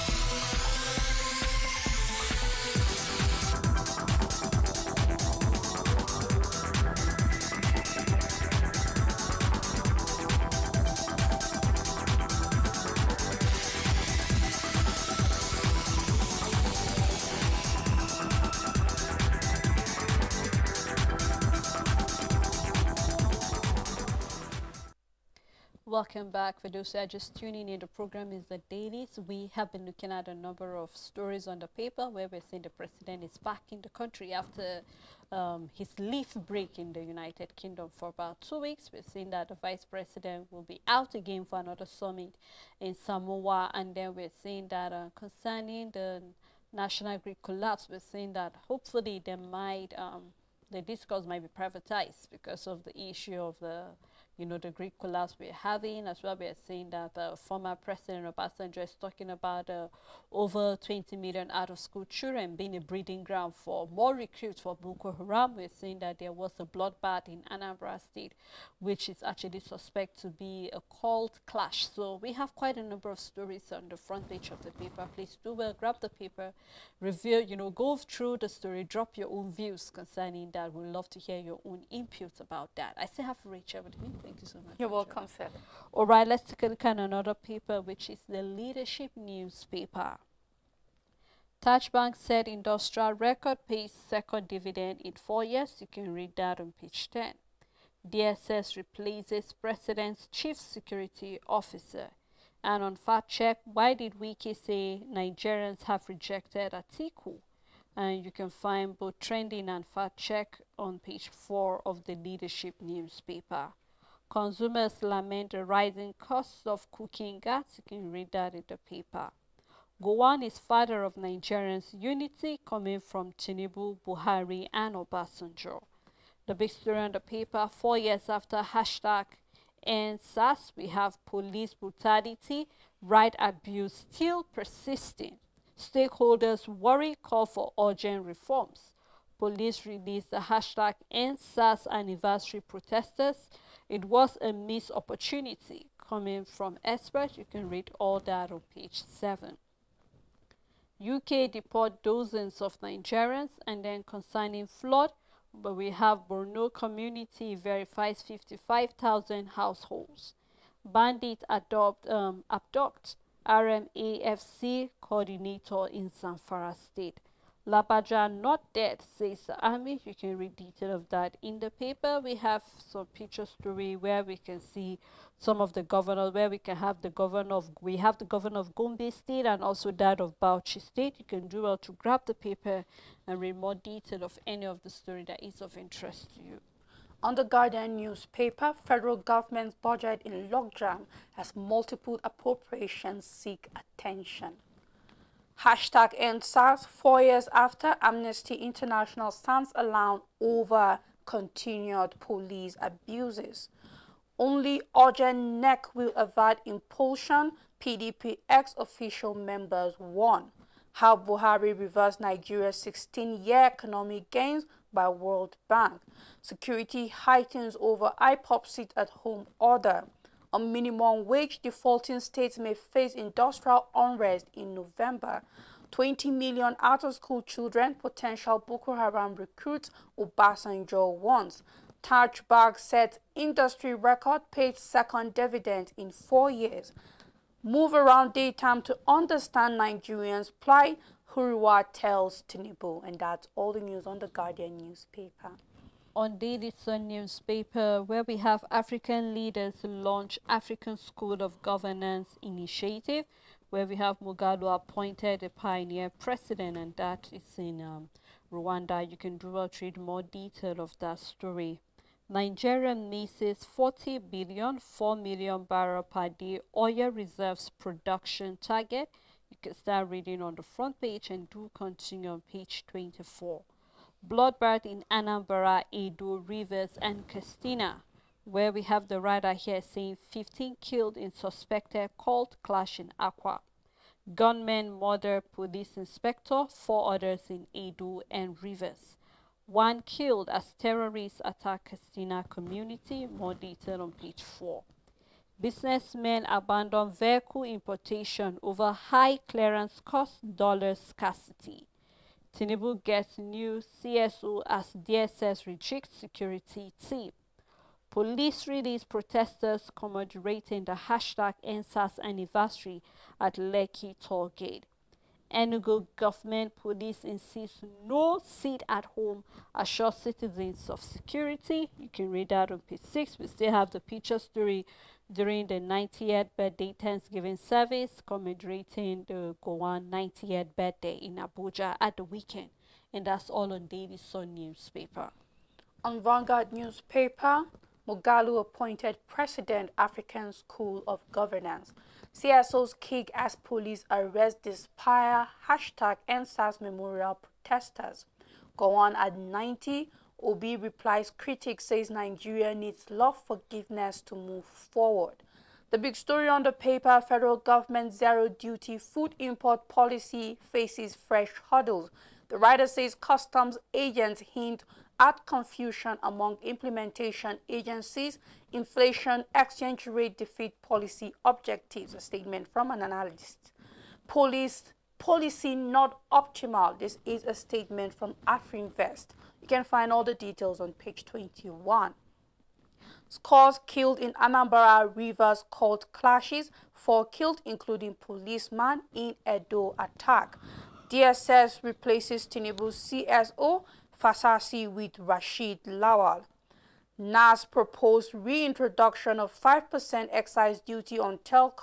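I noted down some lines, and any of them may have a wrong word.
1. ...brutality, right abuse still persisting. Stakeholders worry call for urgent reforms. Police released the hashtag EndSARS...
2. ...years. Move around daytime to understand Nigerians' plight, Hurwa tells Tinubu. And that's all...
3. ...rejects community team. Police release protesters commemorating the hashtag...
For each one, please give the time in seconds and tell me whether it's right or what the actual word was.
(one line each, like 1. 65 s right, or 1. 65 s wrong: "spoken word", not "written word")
1. 131 s right
2. 236 s right
3. 305 s wrong: "security", not "community".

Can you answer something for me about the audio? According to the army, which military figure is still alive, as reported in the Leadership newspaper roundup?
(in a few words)
Lagbaja.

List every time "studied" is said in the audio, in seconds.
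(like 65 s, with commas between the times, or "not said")
not said.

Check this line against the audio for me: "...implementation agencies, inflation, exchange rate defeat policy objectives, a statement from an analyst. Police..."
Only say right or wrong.
right.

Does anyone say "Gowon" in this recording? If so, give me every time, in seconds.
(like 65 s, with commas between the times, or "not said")
120 s, 329 s, 348 s.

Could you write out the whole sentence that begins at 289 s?
One killed as terrorists attack Katsina community, more detail on page 4.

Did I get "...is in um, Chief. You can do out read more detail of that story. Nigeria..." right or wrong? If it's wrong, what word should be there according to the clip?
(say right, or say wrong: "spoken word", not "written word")
wrong: "Rwanda", not "Chief".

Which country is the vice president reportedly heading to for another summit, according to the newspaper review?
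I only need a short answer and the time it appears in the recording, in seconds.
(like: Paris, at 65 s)
Samoa, at 42 s.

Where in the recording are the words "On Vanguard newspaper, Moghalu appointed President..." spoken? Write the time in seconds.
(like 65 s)
336 s.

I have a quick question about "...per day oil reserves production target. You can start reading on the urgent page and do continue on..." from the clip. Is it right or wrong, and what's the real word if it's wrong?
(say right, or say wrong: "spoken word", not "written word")
wrong: "front", not "urgent".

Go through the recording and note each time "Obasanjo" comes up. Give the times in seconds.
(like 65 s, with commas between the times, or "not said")
58 s, 124 s, 230 s.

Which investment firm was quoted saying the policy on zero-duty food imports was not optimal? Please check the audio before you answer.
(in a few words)
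Afrinvest.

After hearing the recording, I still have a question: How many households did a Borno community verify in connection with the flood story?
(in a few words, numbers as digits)
55,000.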